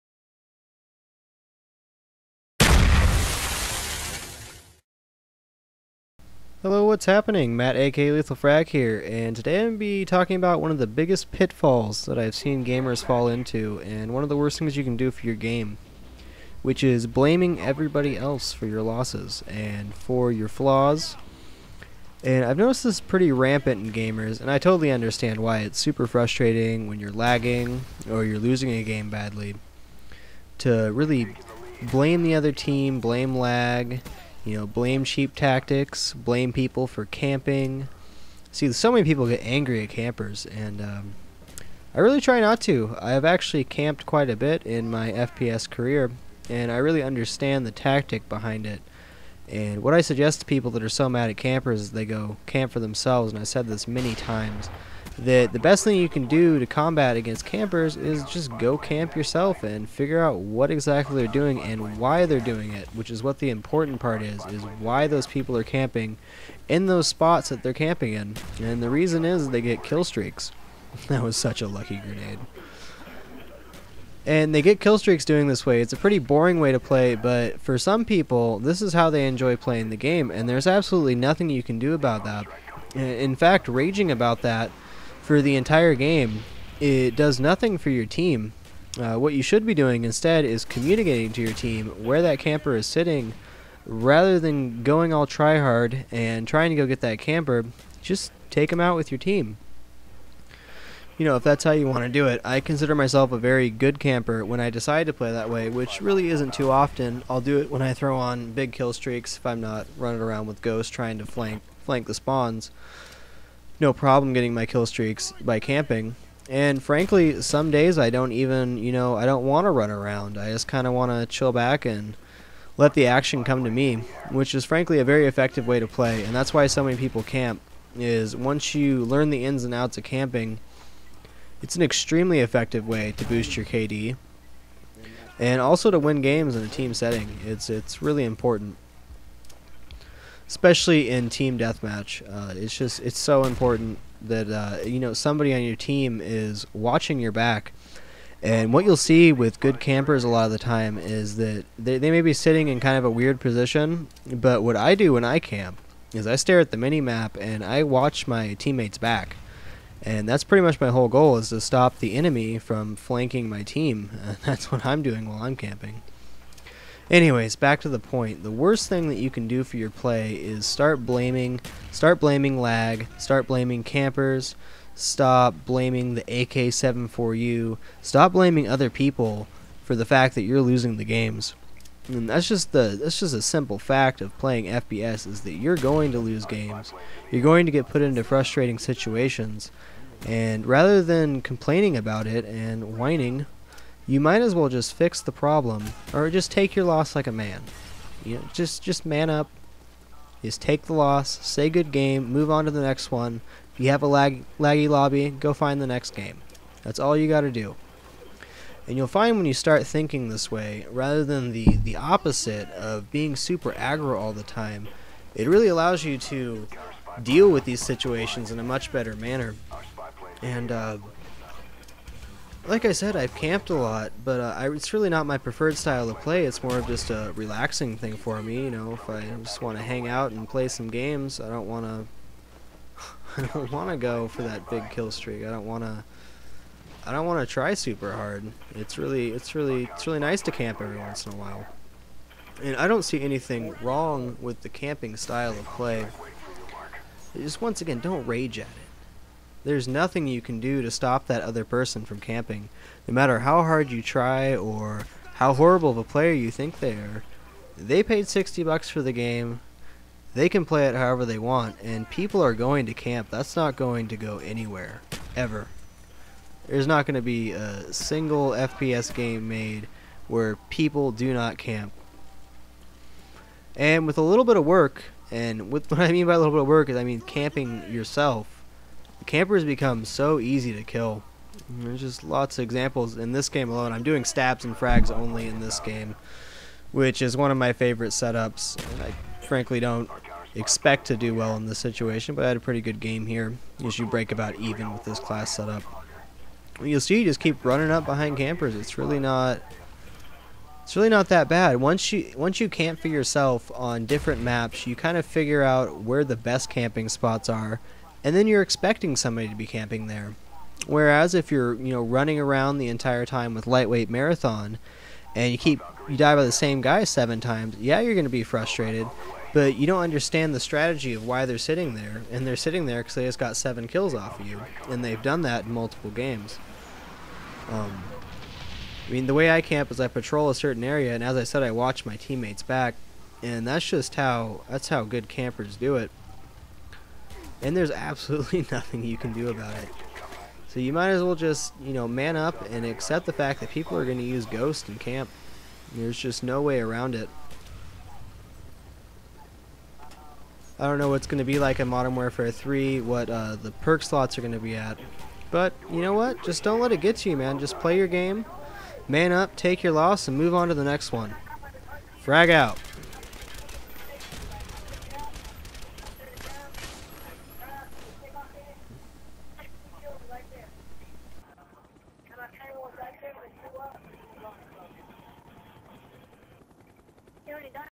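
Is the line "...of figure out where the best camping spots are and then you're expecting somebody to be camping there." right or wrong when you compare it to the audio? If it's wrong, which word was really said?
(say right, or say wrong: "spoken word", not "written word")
right.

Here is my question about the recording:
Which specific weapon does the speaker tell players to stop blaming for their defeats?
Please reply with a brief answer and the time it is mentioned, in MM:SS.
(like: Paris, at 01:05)
AK-74U, at 02:56.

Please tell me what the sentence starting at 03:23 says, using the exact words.
If you have a lag, laggy lobby, go find the next game.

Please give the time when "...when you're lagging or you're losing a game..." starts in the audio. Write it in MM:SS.
00:26.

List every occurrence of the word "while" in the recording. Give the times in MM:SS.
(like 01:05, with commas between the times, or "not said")
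02:45, 04:01.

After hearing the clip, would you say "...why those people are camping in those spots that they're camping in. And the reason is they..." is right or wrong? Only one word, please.
right.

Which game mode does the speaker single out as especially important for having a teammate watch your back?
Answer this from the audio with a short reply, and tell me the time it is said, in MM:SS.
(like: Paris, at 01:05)
Team deathmatch, at 02:21.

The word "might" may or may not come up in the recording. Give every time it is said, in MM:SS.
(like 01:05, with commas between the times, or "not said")
03:14, 05:40.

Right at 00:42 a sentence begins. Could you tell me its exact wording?
I have actually camped quite a bit in my FPS career, and I really understand the tactic behind it.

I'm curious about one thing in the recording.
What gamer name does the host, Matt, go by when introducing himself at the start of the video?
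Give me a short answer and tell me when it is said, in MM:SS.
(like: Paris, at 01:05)
Lethal Frag, at 00:08.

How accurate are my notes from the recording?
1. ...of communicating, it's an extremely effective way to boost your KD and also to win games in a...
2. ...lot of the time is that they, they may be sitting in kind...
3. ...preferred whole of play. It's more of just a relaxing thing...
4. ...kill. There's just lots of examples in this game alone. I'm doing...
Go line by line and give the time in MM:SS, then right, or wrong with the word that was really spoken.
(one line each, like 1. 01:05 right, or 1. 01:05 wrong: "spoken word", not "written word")
1. 02:09 wrong: "camping", not "communicating"
2. 02:30 right
3. 03:45 wrong: "style", not "whole"
4. 04:40 right.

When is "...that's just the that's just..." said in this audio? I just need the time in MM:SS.
03:02.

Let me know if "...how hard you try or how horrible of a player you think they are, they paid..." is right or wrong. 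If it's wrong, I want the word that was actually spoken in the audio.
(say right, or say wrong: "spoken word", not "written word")
right.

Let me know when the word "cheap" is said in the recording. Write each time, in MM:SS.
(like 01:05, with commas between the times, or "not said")
00:35.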